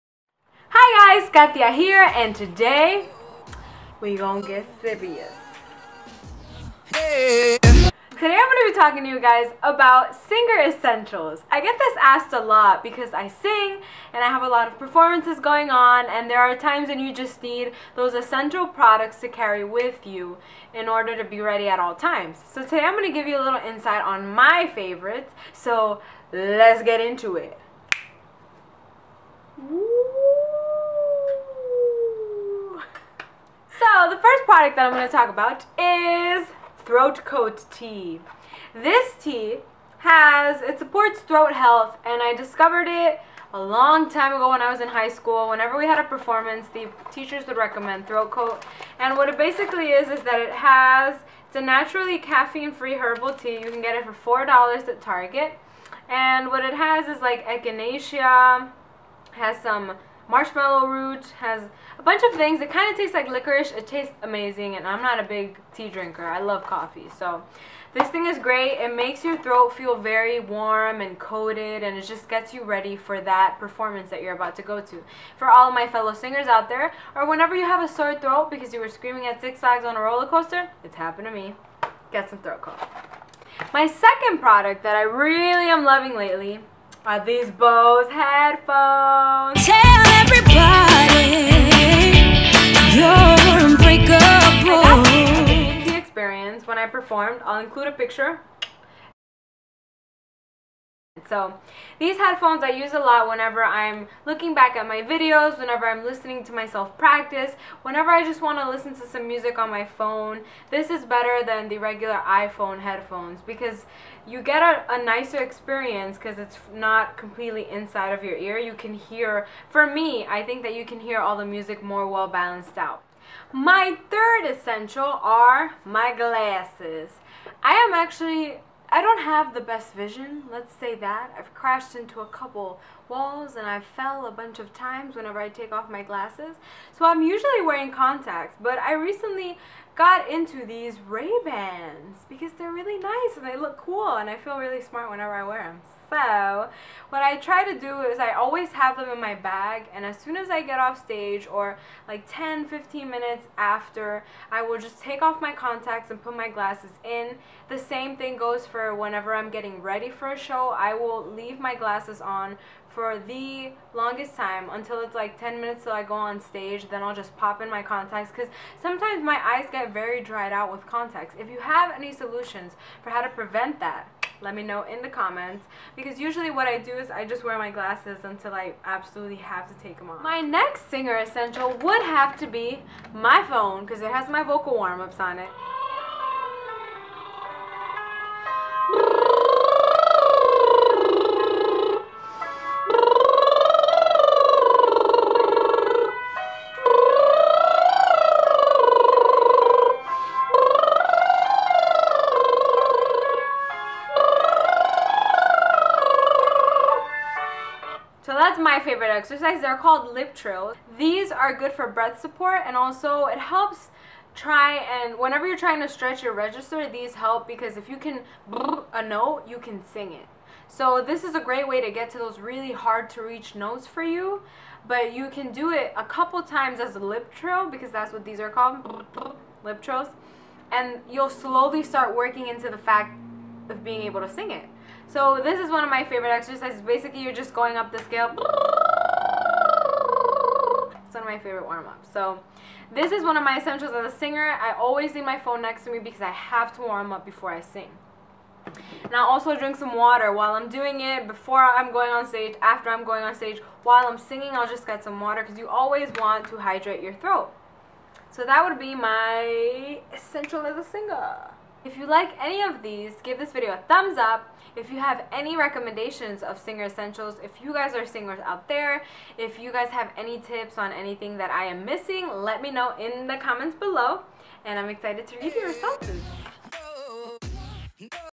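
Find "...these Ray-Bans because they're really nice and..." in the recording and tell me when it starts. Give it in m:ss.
2:20.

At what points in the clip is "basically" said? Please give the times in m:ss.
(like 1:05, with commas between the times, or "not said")
0:49, 3:56.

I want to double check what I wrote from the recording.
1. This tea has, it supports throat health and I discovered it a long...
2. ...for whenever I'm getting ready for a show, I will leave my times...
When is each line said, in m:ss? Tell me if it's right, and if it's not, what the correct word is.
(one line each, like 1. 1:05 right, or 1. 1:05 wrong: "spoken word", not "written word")
1. 0:38 right
2. 2:38 wrong: "glasses", not "times".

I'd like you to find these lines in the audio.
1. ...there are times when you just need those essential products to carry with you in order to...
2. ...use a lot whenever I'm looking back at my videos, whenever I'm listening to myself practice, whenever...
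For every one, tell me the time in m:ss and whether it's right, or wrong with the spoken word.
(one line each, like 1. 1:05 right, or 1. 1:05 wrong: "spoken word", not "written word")
1. 0:16 right
2. 1:42 right.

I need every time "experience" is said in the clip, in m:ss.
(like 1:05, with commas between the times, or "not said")
1:35, 1:55.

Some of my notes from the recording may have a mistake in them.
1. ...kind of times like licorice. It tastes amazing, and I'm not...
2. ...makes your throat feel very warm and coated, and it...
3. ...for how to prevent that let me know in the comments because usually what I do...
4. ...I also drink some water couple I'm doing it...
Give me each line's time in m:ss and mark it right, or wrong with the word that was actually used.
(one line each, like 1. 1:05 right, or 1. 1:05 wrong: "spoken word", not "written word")
1. 1:02 wrong: "tastes", not "times"
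2. 1:08 right
3. 2:53 right
4. 4:09 wrong: "while", not "couple".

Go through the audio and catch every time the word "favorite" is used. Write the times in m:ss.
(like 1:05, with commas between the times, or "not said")
0:24, 3:28, 3:56, 4:01.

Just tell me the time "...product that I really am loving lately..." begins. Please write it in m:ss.
1:24.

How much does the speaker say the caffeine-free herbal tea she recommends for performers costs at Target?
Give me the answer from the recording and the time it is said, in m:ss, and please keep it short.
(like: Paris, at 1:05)
$4, at 0:54.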